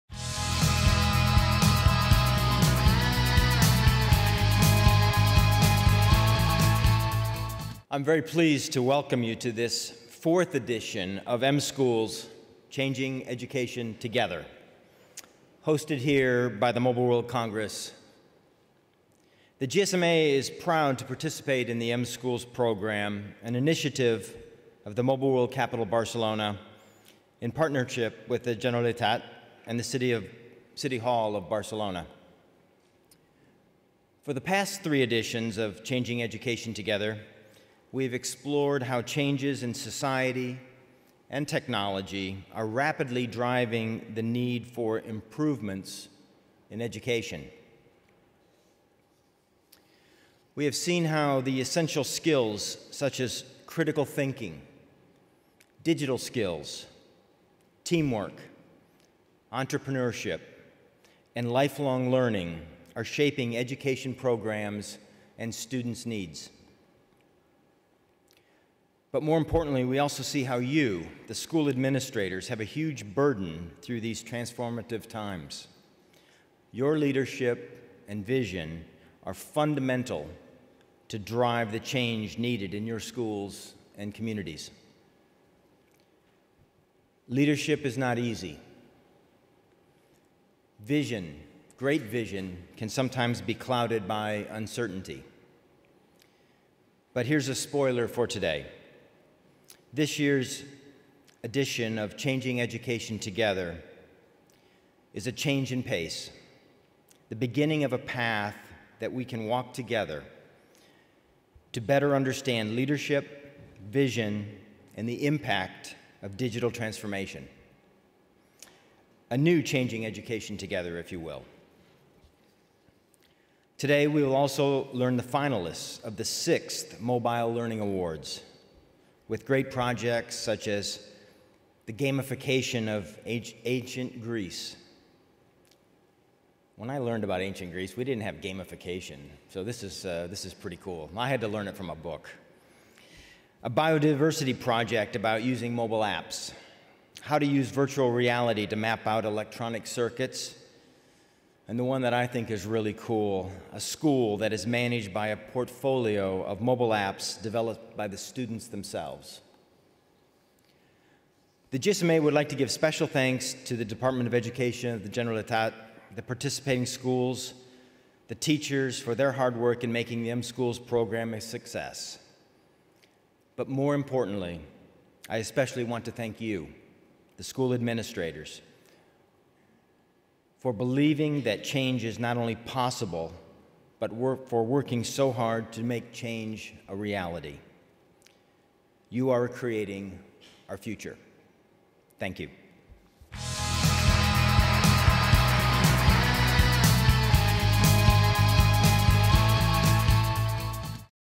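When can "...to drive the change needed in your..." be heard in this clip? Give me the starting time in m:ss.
1:21.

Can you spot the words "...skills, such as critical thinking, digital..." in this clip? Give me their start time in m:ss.
0:52.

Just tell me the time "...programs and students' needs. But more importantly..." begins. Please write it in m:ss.
1:04.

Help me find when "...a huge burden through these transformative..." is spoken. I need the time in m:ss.
1:12.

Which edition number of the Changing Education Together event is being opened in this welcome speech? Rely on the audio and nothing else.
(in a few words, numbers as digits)
fourth.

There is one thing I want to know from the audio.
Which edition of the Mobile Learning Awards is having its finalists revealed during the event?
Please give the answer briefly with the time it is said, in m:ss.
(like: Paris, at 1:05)
sixth, at 2:06.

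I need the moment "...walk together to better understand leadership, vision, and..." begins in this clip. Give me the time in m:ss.
1:49.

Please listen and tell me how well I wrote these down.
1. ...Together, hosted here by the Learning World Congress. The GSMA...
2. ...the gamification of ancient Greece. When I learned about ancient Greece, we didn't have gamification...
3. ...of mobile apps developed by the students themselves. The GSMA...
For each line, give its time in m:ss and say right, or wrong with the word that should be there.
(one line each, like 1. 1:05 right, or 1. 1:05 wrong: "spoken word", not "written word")
1. 0:13 wrong: "Mobile", not "Learning"
2. 2:11 right
3. 2:36 right.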